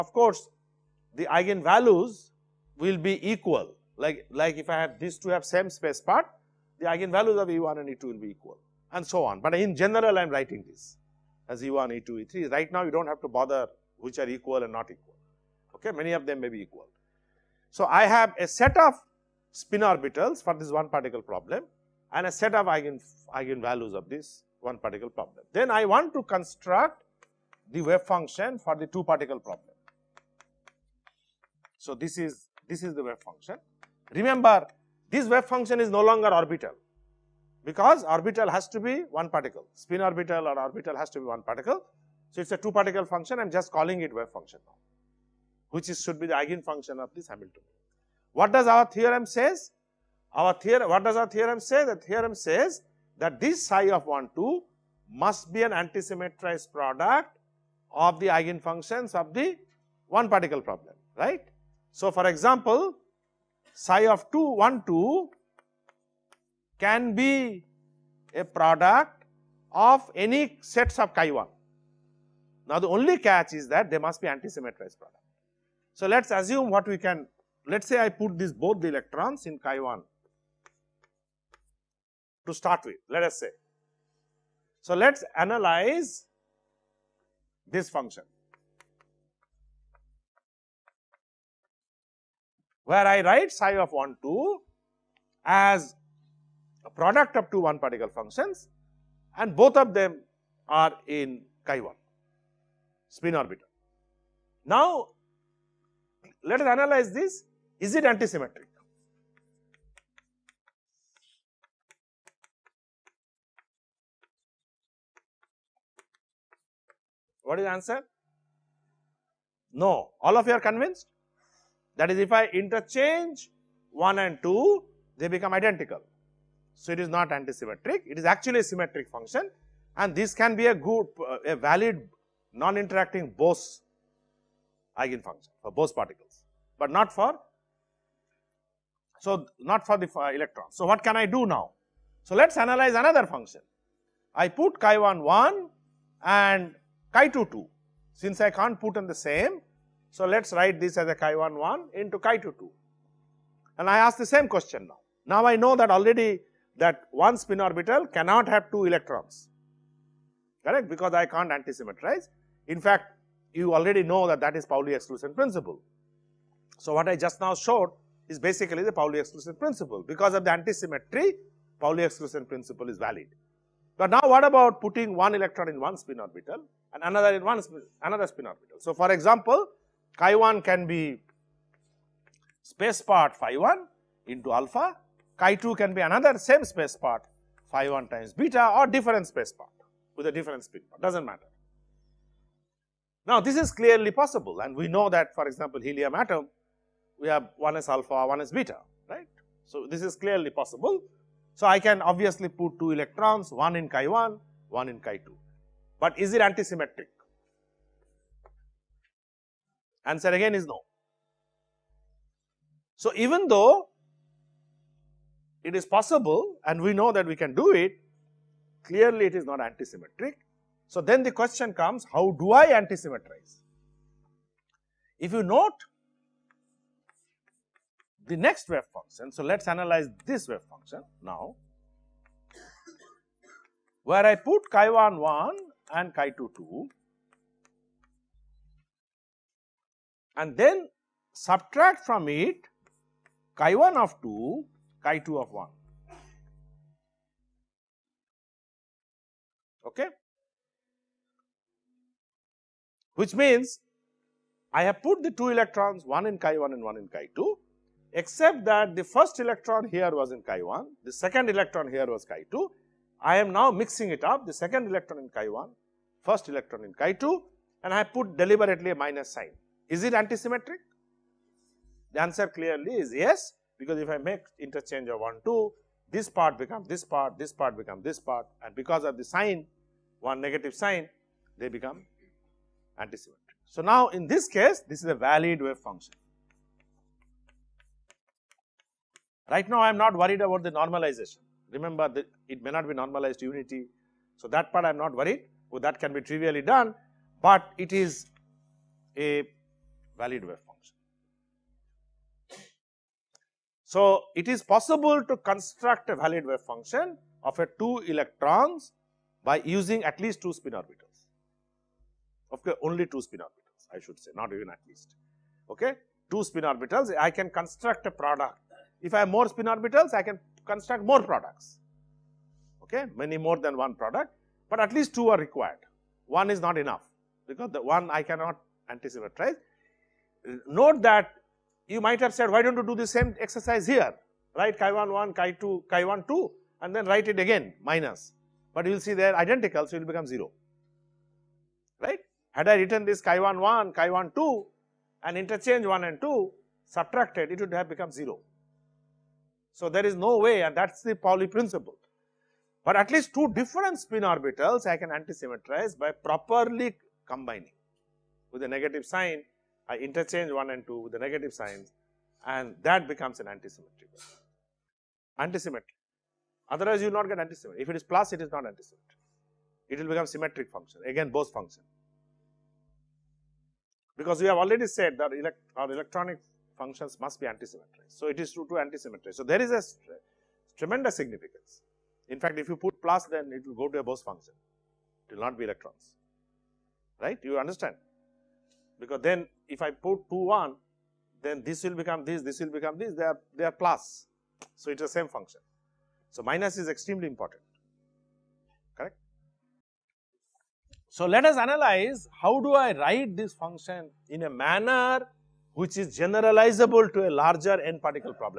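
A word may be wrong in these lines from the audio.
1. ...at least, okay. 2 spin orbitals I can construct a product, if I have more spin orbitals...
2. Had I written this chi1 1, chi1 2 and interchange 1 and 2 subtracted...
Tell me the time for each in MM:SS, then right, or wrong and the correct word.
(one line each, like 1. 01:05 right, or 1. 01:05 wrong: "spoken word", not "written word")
1. 05:14 right
2. 05:42 right.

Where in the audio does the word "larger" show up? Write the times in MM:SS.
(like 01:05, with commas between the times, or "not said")
06:47.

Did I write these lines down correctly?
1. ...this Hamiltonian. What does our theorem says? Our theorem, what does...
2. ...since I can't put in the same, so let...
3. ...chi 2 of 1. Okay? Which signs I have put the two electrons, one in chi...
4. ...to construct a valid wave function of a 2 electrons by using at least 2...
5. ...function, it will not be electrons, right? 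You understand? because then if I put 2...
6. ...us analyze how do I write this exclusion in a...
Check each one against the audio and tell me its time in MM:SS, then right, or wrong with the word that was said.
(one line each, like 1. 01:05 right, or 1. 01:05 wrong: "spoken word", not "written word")
1. 00:47 right
2. 02:28 right
3. 04:05 wrong: "means", not "signs"
4. 05:05 right
5. 06:24 right
6. 06:41 wrong: "function", not "exclusion".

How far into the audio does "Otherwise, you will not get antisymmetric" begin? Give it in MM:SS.
06:06.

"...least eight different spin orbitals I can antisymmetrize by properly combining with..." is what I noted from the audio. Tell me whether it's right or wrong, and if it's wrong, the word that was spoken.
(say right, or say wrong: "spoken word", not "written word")
wrong: "two", not "eight".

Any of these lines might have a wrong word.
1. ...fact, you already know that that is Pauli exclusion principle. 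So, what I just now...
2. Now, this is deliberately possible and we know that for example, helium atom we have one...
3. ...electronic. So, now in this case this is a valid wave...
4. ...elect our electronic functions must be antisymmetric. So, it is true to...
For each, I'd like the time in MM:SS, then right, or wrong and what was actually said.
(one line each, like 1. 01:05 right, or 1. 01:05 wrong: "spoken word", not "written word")
1. 02:42 right
2. 03:13 wrong: "clearly", not "deliberately"
3. 04:43 wrong: "antisymmetric", not "electronic"
4. 06:15 right.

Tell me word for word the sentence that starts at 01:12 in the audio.
Now, the only catch is that they must be antisymmetrized product.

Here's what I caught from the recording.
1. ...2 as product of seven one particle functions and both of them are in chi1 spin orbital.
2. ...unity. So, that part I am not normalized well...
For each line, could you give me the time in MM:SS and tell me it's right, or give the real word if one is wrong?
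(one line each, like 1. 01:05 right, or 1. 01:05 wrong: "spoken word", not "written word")
1. 01:34 wrong: "two", not "seven"
2. 04:53 wrong: "worried", not "normalized".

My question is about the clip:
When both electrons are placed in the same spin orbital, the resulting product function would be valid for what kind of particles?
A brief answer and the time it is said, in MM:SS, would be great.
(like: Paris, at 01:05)
Bose particles, at 02:15.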